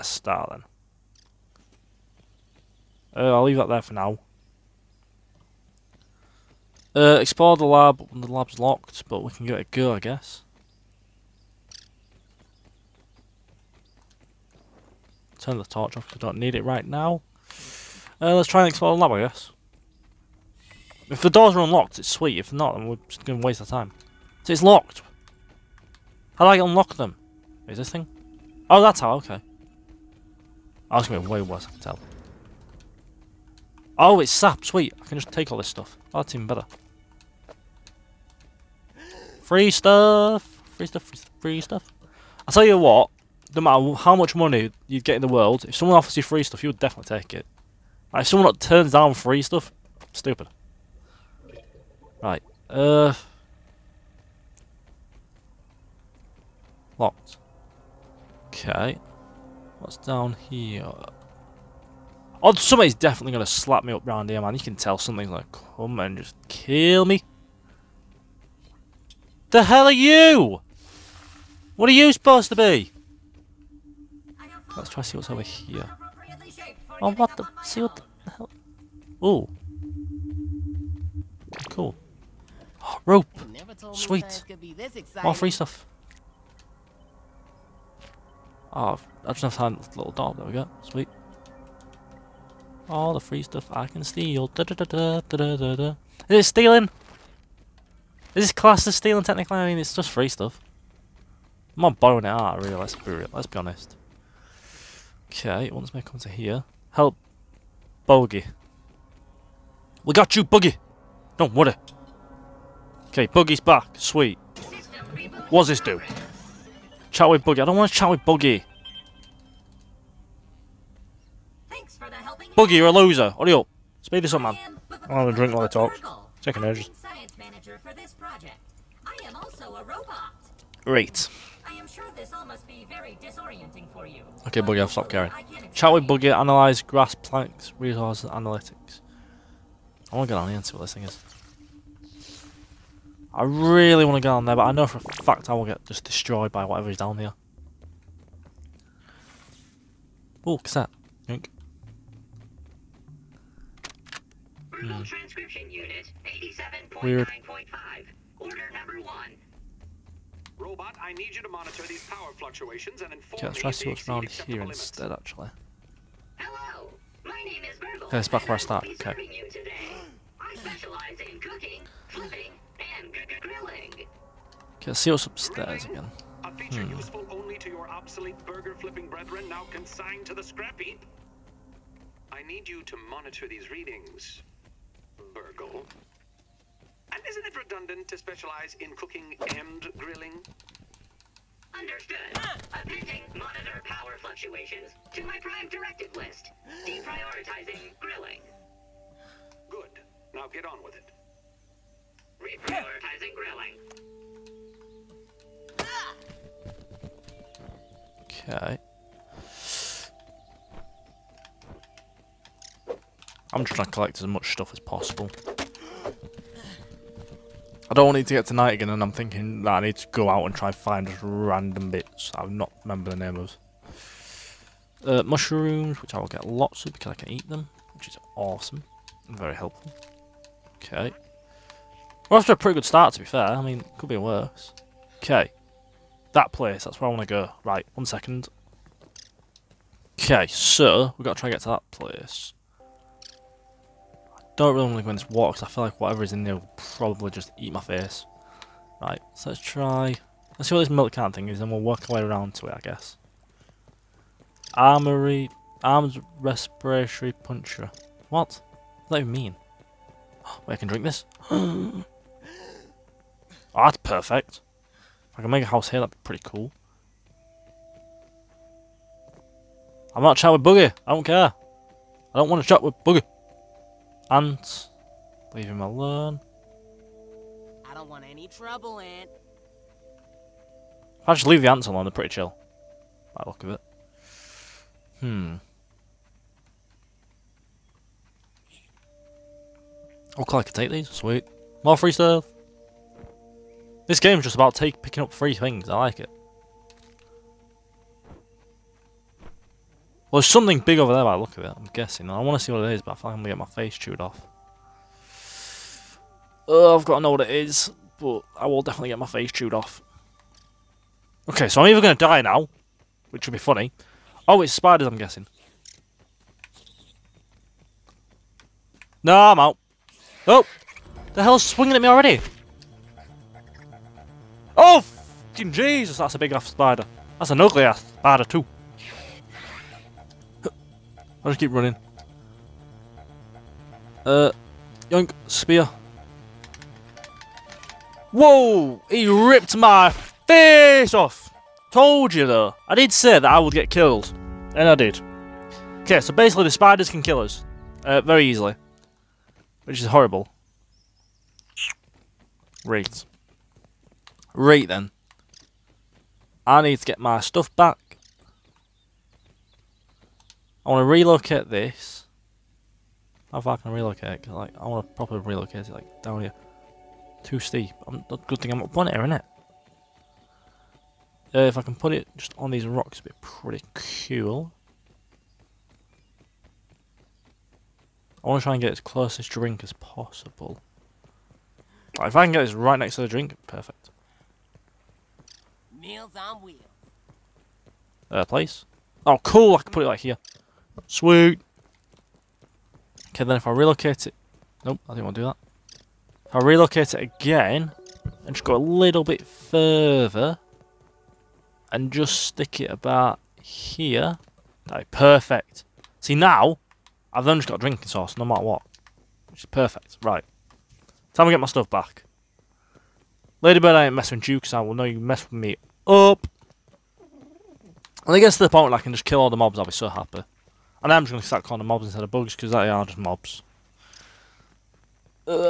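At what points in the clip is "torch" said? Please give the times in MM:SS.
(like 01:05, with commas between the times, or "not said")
00:15.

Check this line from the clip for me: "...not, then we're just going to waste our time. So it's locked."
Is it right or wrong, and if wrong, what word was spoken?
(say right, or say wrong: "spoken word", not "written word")
right.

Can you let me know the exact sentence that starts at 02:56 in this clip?
useful only to your obsolete burger flipping brethren now consigned to the scrap heap.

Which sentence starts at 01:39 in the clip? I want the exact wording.
I mean, it's just free stuff.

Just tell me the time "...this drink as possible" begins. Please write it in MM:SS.
06:19.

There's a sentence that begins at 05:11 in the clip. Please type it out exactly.
Okay, so I'm either going to die now, which would be funny.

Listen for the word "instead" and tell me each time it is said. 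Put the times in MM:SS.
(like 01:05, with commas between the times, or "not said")
02:44, 07:02.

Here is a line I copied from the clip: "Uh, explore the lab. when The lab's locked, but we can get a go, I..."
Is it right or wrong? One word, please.
right.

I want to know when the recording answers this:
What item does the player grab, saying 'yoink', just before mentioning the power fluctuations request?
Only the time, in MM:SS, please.
02:30.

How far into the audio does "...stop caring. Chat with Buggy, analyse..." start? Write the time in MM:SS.
02:14.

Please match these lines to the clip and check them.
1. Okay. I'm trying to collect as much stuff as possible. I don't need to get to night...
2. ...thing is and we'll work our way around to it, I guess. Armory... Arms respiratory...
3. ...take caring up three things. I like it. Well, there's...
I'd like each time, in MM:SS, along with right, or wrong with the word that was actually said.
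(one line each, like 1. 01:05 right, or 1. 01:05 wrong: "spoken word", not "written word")
1. 03:28 right
2. 04:11 right
3. 04:54 wrong: "picking", not "caring".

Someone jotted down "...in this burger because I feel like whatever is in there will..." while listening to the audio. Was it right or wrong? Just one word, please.
wrong.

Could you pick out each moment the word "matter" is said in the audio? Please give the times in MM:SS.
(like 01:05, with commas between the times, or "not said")
00:43, 06:48.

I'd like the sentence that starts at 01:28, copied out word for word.
Oh, I just have to hand little doll.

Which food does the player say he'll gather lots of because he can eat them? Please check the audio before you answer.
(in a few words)
Mushrooms.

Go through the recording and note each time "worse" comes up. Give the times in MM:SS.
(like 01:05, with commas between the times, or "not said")
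00:31, 03:54.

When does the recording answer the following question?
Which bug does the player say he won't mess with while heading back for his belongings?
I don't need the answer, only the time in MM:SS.
06:53.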